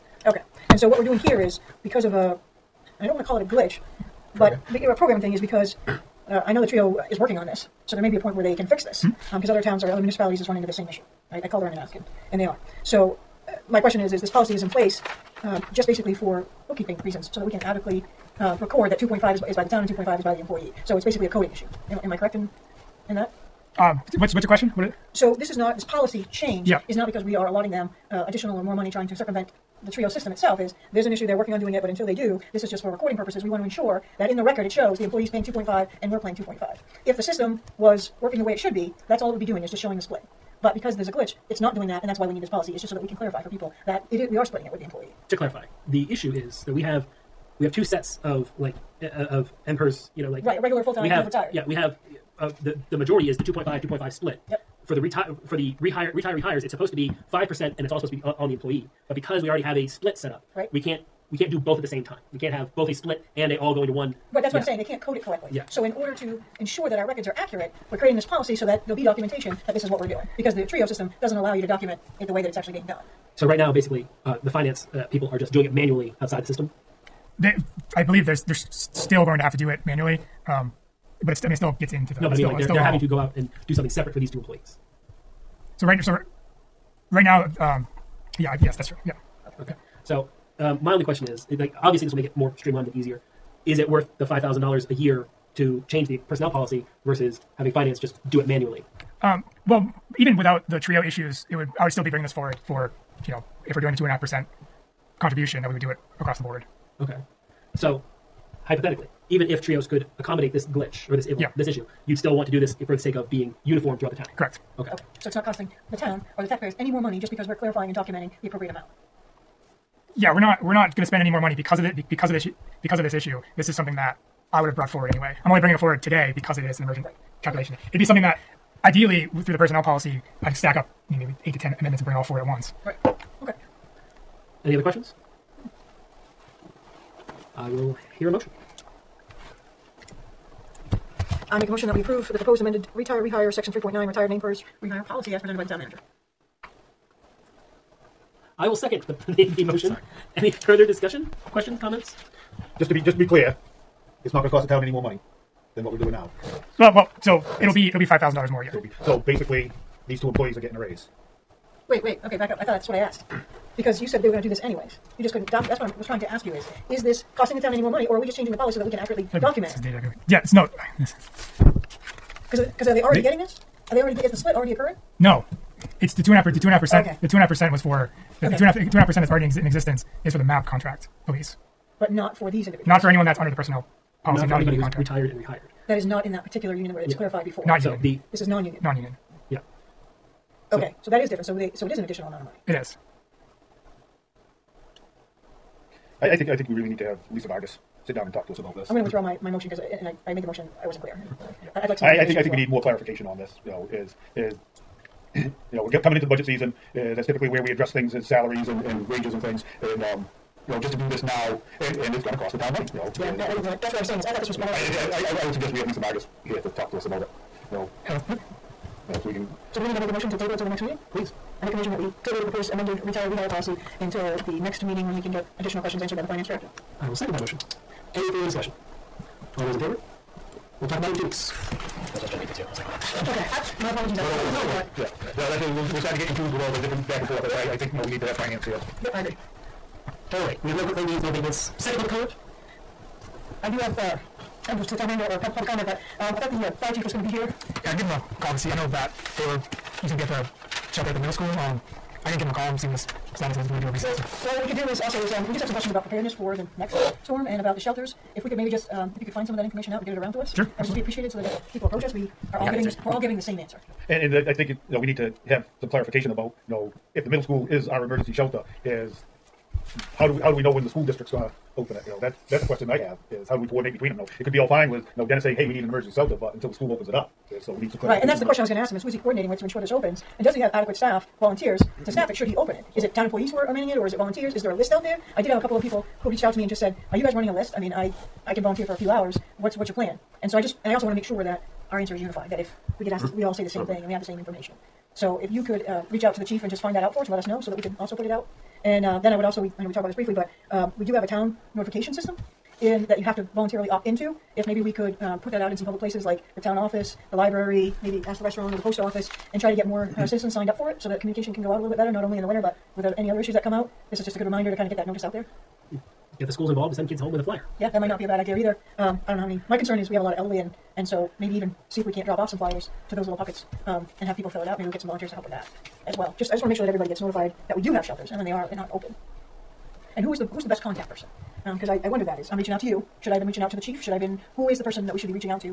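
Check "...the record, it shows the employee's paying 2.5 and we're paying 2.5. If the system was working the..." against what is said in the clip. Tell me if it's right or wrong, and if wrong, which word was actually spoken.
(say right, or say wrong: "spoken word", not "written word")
right.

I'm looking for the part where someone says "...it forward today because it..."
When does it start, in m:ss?
2:05.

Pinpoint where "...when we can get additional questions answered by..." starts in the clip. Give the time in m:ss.
3:45.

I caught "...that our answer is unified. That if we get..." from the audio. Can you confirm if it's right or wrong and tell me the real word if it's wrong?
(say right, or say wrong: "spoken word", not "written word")
right.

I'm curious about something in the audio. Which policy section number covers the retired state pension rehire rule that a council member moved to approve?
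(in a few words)
3.9.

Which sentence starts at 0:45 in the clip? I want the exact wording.
To clarify, the issue is that we have we have two sets of like uh, uh of emperors.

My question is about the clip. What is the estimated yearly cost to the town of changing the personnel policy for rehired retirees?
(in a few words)
$5,000.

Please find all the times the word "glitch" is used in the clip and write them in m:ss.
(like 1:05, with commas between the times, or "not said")
0:03, 0:41, 1:50.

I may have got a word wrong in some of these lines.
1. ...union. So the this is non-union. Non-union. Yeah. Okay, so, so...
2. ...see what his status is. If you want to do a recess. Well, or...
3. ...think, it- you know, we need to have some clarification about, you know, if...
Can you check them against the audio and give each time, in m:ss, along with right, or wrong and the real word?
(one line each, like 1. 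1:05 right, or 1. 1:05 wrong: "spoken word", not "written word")
1. 3:07 right
2. 4:12 right
3. 4:24 right.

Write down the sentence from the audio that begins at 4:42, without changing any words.
Is it town employees who are, are manning it, or is it volunteers?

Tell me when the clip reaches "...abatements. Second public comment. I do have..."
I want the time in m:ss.
4:01.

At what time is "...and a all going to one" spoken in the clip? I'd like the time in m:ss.
1:03.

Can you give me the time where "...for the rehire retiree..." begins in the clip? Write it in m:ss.
0:55.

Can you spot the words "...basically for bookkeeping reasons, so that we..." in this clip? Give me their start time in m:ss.
0:15.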